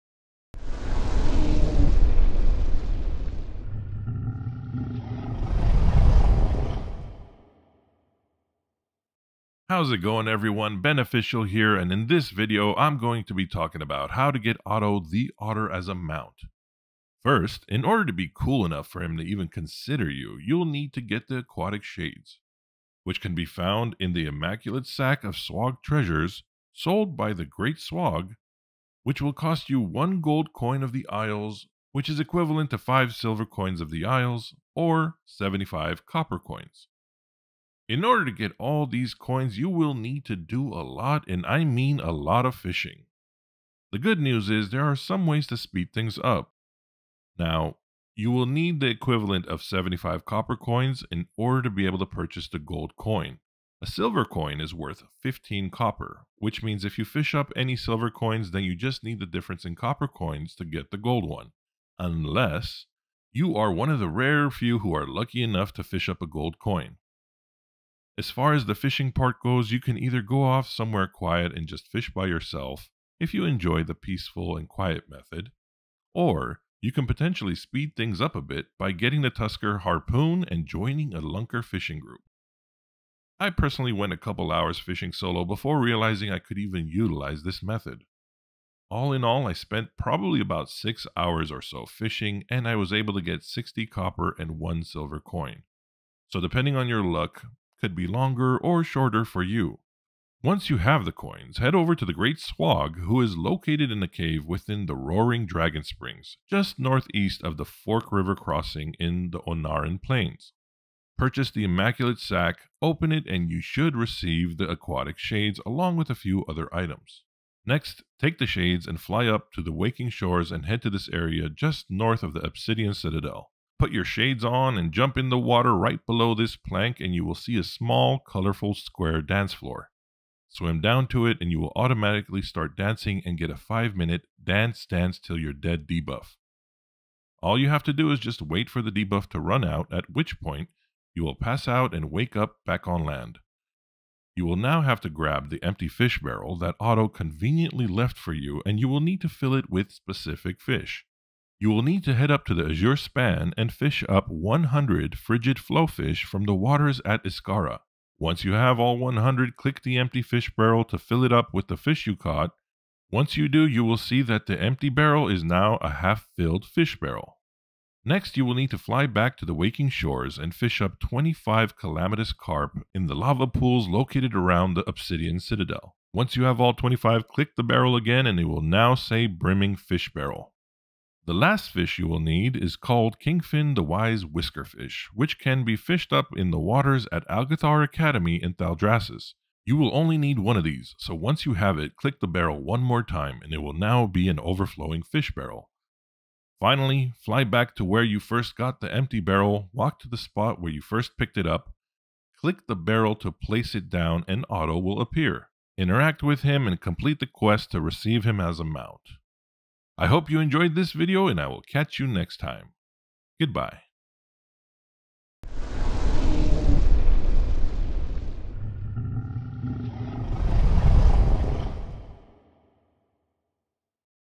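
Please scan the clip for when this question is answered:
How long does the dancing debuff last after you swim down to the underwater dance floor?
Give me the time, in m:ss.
2:13.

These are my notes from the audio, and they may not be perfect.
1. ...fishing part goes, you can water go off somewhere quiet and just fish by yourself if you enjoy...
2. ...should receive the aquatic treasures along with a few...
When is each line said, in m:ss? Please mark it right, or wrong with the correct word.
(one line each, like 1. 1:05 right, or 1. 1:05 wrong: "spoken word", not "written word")
1. 1:08 wrong: "either", not "water"
2. 1:53 wrong: "shades", not "treasures".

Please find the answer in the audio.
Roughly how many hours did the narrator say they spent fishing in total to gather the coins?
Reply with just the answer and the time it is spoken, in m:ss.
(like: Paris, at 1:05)
6 hours, at 1:30.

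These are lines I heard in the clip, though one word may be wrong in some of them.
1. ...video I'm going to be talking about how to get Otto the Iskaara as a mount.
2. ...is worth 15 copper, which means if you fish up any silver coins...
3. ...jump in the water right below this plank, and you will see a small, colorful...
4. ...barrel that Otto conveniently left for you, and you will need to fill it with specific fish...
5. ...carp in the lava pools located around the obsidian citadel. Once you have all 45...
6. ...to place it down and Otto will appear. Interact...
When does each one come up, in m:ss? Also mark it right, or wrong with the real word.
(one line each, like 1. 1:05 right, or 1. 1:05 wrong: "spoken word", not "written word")
1. 0:12 wrong: "Otter", not "Iskaara"
2. 0:54 right
3. 2:04 right
4. 2:26 right
5. 2:52 wrong: "25", not "45"
6. 3:23 right.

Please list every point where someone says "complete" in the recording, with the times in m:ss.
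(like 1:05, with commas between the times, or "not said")
3:26.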